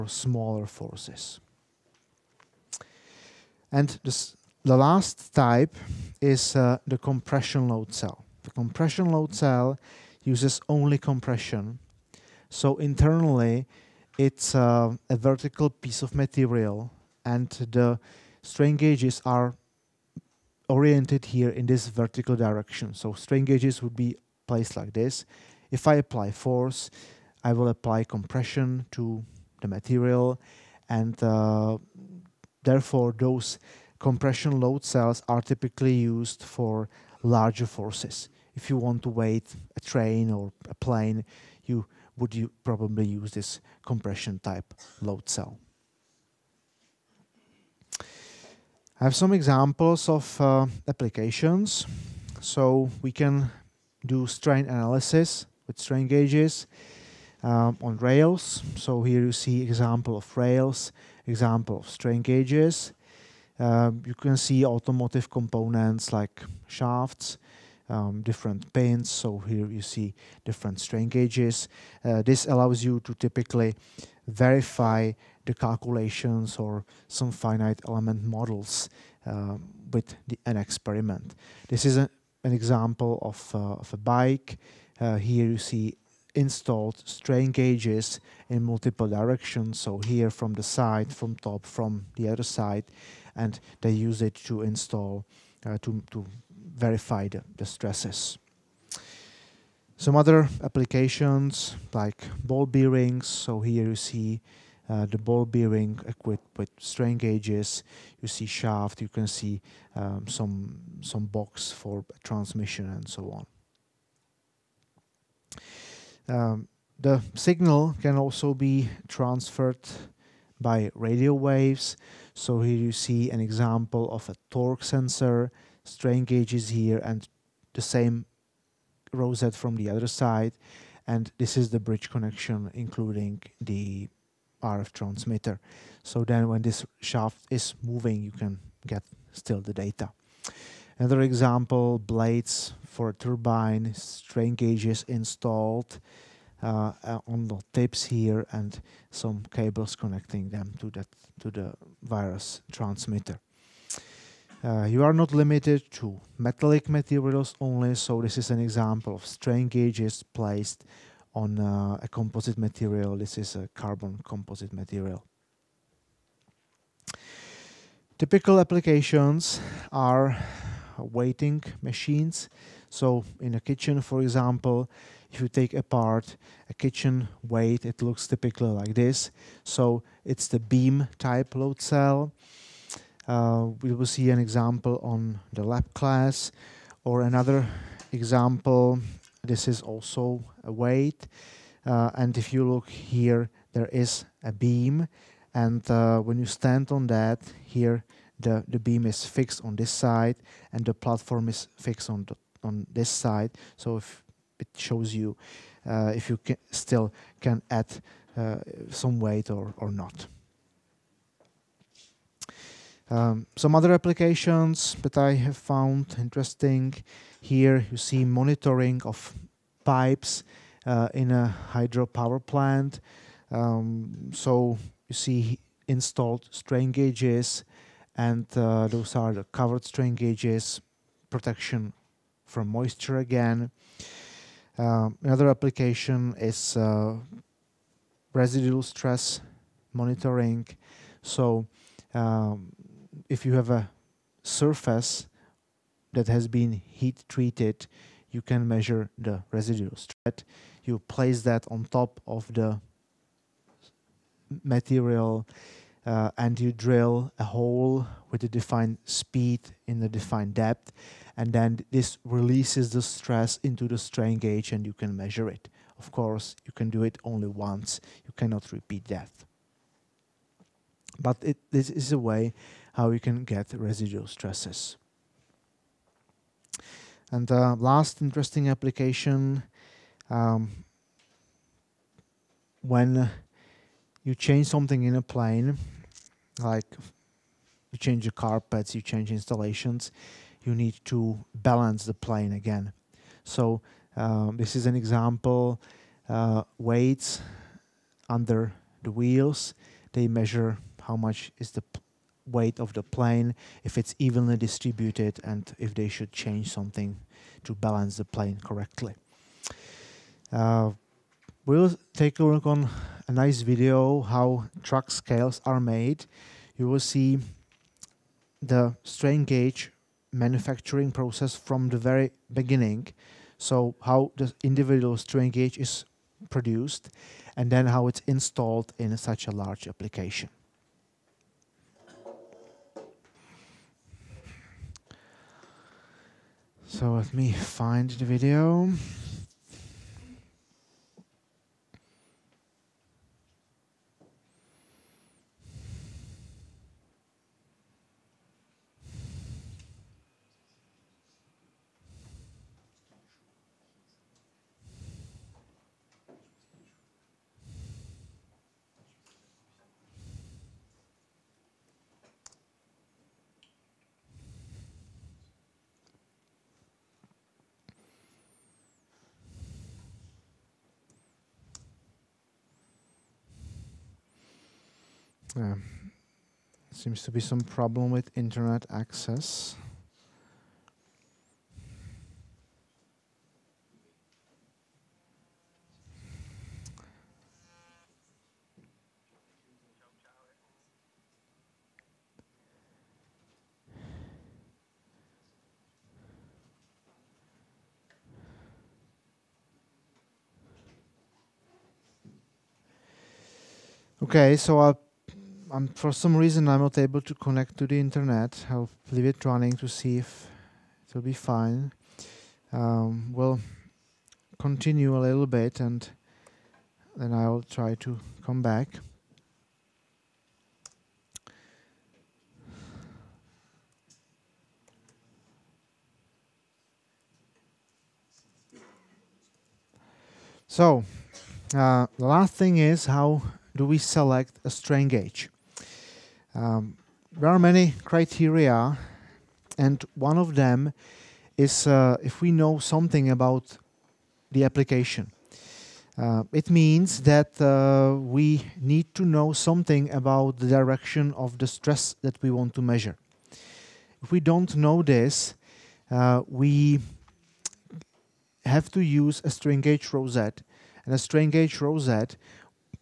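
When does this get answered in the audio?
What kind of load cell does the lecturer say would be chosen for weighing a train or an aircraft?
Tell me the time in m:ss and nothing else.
0:43.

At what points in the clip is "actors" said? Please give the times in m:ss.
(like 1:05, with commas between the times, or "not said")
not said.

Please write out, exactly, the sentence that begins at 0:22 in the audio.
So strain gauges would be placed like this.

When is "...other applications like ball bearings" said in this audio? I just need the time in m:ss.
1:40.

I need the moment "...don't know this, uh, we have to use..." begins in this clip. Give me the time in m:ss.
7:34.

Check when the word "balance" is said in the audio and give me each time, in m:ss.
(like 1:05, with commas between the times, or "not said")
4:51, 5:07.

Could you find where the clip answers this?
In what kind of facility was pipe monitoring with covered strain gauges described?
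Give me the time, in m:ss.
3:41.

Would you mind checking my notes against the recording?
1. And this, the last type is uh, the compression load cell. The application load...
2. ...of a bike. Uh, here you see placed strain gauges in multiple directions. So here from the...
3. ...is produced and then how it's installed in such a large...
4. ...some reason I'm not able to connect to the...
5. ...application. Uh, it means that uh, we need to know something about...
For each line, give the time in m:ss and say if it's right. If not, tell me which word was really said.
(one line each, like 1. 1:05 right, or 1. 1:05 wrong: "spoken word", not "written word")
1. 0:03 wrong: "compression", not "application"
2. 1:23 wrong: "installed", not "placed"
3. 5:25 right
4. 6:46 right
5. 7:24 right.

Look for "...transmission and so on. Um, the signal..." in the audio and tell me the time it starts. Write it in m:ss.
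1:52.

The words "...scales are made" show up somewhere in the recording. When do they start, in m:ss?
5:15.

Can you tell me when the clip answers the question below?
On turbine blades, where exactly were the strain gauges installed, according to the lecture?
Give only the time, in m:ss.
2:27.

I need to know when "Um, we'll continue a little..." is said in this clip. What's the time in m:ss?
6:52.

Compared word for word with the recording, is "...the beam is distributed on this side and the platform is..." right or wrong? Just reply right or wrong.
wrong.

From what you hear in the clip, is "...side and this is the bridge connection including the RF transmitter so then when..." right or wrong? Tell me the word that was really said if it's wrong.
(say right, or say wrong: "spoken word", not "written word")
right.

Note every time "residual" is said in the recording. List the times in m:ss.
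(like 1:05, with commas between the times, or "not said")
3:58, 4:09, 4:33.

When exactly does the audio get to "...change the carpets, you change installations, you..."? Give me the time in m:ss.
4:47.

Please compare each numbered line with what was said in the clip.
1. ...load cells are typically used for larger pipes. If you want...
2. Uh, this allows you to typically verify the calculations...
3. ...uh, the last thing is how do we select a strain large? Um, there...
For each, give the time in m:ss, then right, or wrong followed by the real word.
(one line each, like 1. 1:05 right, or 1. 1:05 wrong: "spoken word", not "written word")
1. 0:34 wrong: "forces", not "pipes"
2. 1:12 right
3. 7:11 wrong: "gauge", not "large".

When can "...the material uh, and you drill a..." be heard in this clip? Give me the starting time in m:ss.
4:12.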